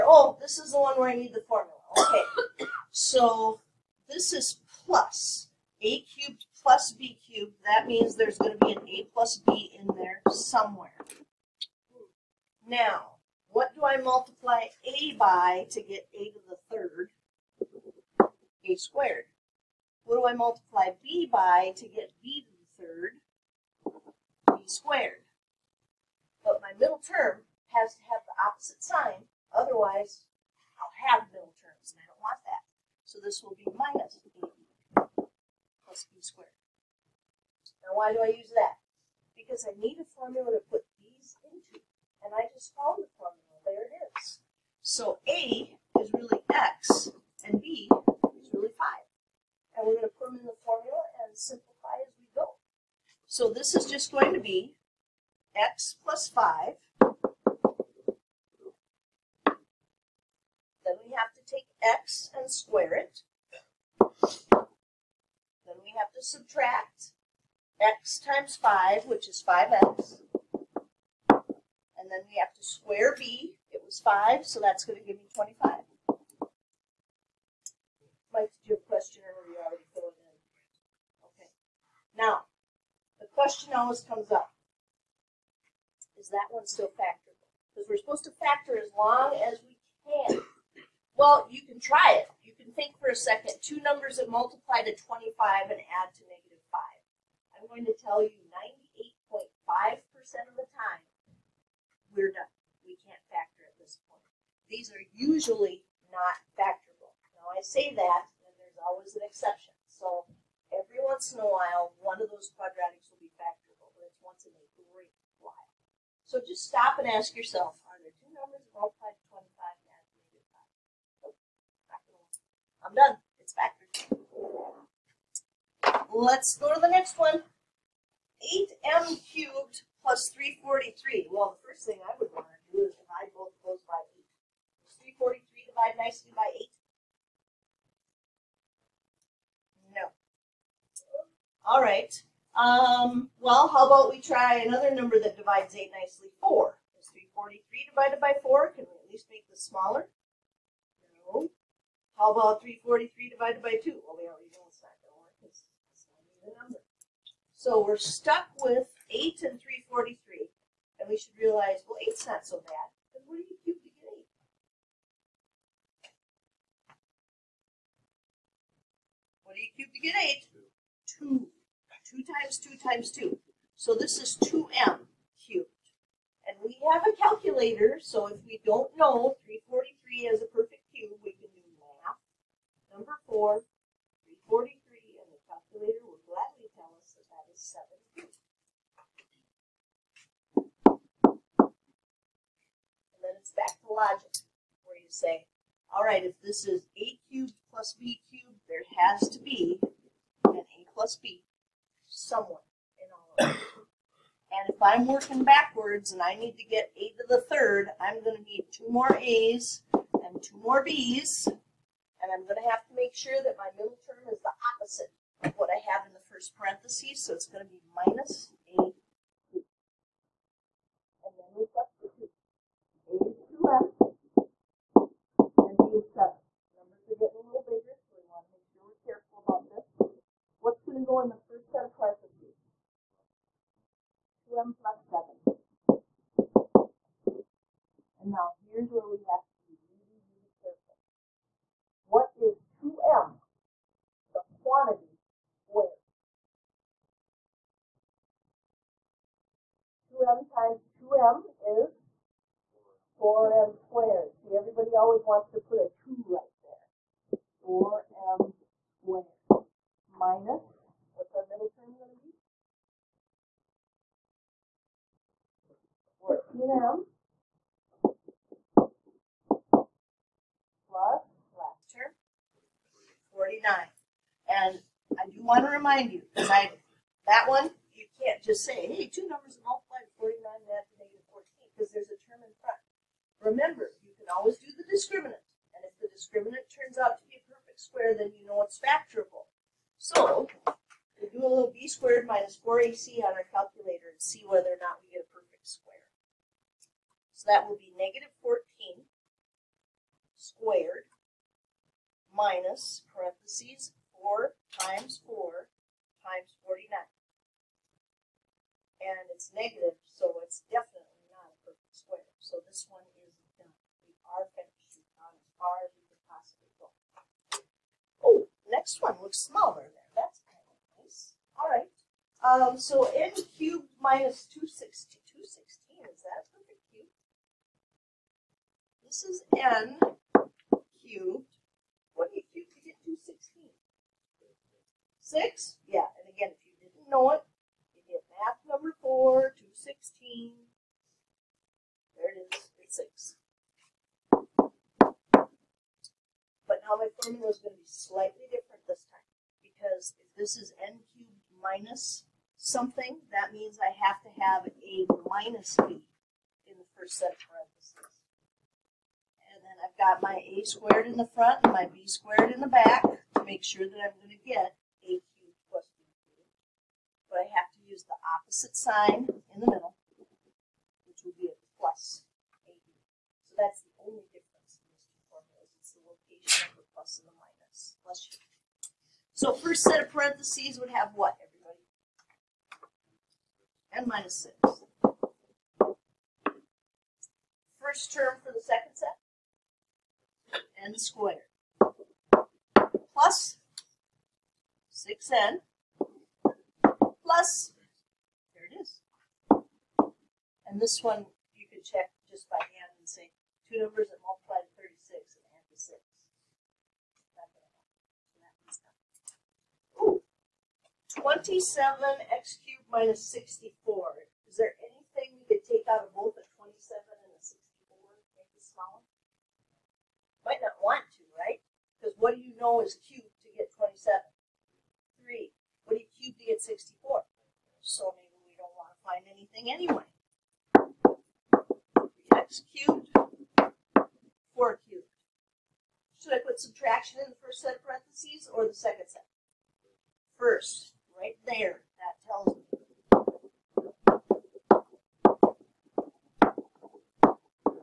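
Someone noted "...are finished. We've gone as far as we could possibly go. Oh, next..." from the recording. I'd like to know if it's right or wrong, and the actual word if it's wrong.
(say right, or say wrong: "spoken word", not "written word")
right.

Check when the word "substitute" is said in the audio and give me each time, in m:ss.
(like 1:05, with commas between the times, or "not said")
3:41.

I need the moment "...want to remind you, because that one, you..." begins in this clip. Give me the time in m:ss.
4:35.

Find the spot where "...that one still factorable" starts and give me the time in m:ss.
1:26.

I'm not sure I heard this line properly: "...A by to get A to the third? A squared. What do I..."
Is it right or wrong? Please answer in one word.
right.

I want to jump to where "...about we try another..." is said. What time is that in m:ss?
2:23.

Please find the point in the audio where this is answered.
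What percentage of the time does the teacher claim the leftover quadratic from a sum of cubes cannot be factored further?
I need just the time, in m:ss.
1:39.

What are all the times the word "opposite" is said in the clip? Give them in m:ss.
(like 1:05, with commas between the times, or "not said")
0:28, 3:34, 6:08.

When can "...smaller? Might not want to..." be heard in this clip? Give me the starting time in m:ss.
6:58.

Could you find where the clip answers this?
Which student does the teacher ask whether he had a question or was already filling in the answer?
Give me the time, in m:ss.
1:18.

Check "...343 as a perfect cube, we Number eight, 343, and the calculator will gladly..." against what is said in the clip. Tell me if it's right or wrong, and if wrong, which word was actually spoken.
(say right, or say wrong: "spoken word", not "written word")
wrong: "four", not "eight".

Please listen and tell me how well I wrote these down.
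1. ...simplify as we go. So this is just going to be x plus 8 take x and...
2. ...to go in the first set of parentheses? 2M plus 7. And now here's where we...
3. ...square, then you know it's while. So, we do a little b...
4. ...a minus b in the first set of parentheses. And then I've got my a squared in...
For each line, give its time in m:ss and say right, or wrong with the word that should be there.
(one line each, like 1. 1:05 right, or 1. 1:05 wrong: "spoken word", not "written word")
1. 0:51 wrong: "5", not "8"
2. 3:50 right
3. 4:47 wrong: "factorable", not "while"
4. 5:54 right.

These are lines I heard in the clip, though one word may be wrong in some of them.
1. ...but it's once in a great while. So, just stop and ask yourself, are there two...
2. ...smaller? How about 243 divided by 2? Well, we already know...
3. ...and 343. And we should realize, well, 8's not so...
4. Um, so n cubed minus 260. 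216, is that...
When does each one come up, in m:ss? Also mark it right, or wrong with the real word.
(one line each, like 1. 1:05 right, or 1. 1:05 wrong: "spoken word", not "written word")
1. 1:53 right
2. 2:29 wrong: "343", not "243"
3. 2:39 right
4. 5:22 right.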